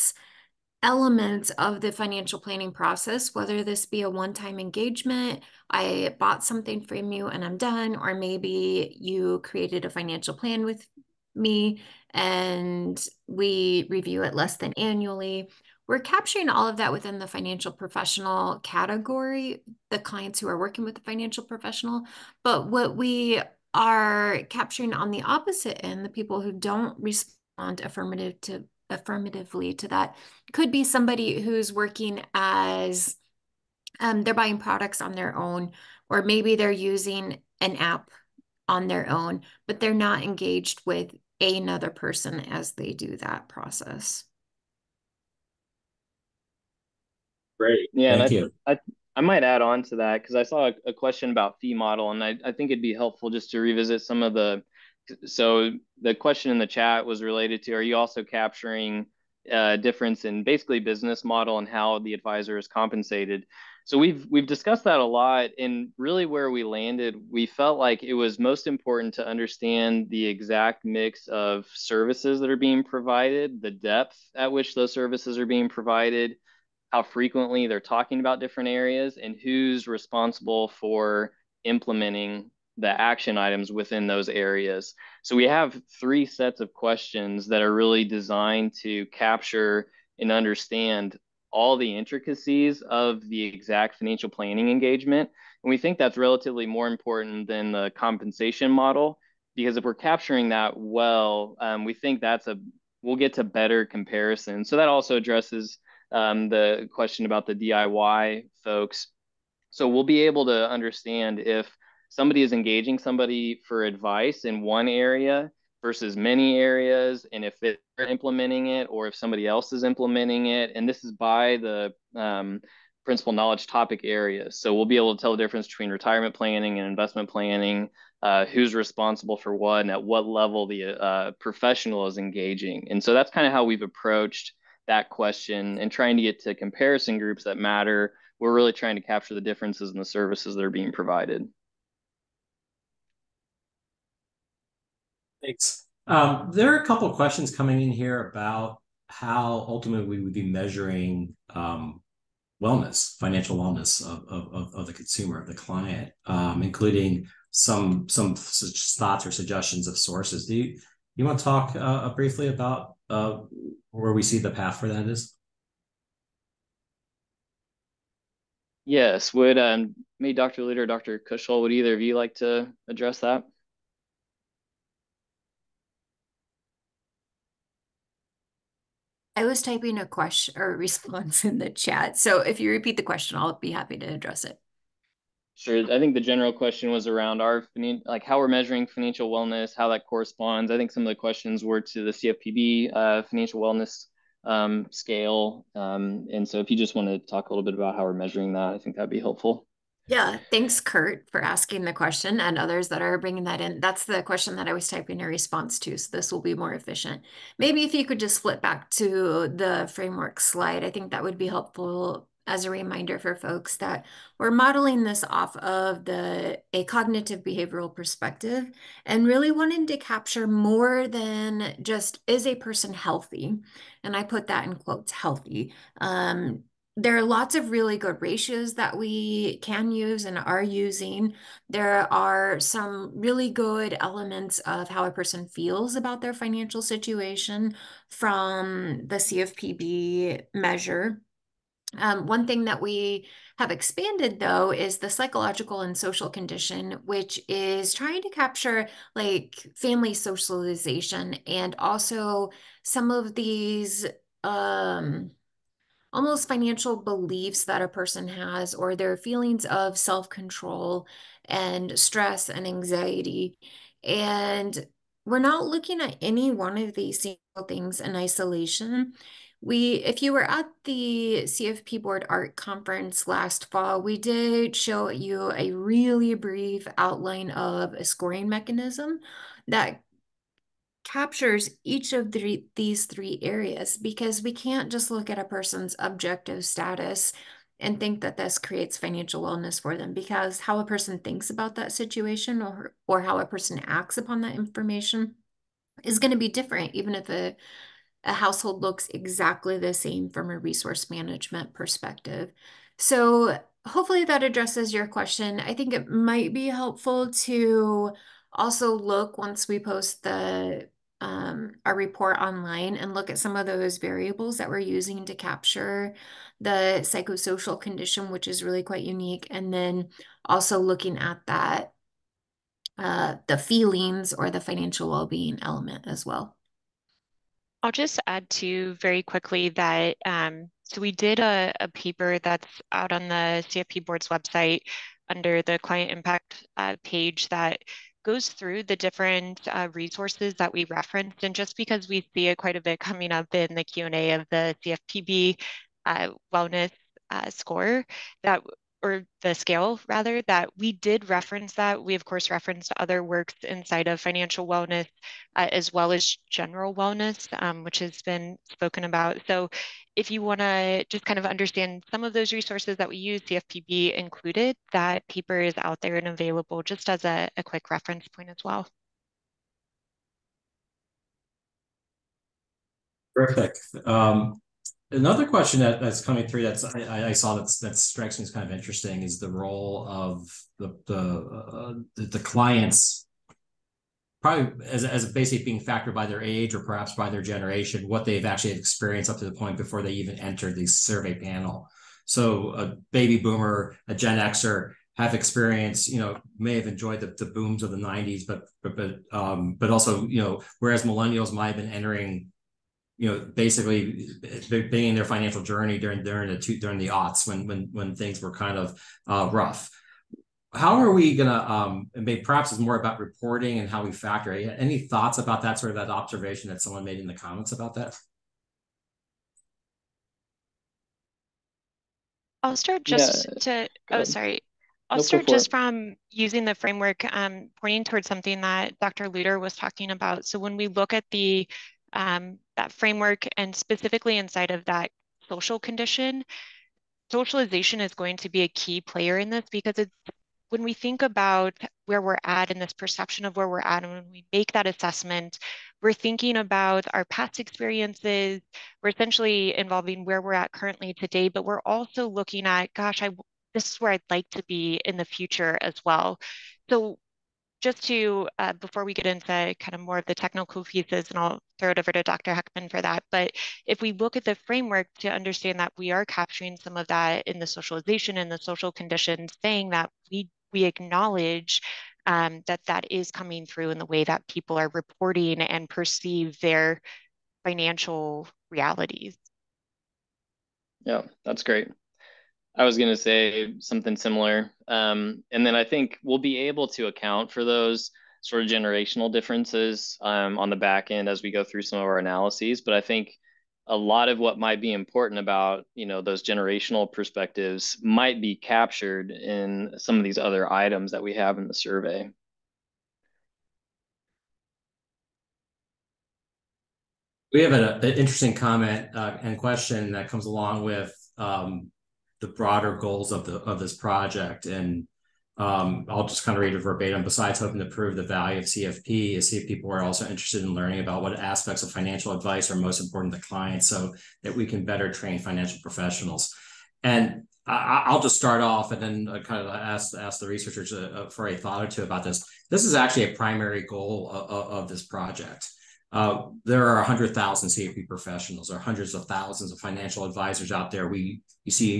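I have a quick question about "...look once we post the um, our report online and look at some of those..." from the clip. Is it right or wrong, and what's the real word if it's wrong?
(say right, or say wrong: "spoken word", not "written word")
right.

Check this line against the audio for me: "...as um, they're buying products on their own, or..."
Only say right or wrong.
right.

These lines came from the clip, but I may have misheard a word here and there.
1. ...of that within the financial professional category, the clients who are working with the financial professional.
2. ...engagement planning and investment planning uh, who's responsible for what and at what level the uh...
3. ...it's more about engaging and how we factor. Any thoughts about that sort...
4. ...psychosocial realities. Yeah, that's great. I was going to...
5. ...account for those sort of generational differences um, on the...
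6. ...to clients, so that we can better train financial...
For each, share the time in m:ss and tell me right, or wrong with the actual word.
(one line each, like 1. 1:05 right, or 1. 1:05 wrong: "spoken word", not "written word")
1. 0:16 right
2. 2:05 wrong: "retirement", not "engagement"
3. 6:52 wrong: "reporting", not "engaging"
4. 7:57 wrong: "financial", not "psychosocial"
5. 8:07 right
6. 8:43 right.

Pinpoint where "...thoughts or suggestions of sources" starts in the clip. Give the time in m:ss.
2:38.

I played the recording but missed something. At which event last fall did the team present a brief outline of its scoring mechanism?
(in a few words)
CFP Board Art Conference.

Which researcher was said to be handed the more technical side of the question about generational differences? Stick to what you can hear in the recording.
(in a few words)
Dr. Heckman.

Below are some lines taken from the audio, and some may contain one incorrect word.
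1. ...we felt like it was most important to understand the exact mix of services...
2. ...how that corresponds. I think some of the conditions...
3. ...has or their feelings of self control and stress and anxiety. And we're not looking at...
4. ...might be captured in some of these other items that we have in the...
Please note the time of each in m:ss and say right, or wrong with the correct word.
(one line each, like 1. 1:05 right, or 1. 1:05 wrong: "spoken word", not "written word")
1. 1:07 right
2. 3:09 wrong: "questions", not "conditions"
3. 4:18 right
4. 8:18 right.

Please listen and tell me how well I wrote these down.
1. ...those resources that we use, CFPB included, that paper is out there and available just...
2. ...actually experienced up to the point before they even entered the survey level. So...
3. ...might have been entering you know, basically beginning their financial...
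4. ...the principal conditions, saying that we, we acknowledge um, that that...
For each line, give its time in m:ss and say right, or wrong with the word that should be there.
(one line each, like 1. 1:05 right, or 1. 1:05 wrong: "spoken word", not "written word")
1. 6:02 right
2. 6:28 wrong: "panel", not "level"
3. 6:41 right
4. 7:48 wrong: "social", not "principal".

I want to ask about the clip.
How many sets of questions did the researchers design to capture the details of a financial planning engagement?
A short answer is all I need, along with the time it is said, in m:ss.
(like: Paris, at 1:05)
3, at 1:25.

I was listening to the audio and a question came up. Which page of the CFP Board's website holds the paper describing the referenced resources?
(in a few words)
Client impact.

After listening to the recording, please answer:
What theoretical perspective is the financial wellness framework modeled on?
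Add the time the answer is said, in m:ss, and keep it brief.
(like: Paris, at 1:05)
Cognitive behavioral, at 3:36.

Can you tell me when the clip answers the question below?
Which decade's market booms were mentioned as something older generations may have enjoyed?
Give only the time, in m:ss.
6:37.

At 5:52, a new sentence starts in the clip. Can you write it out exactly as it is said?
We of course referenced other works inside of financial wellness uh, as well as general wellness, um, which has been spoken about.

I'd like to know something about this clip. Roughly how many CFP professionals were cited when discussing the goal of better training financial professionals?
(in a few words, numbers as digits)
100,000.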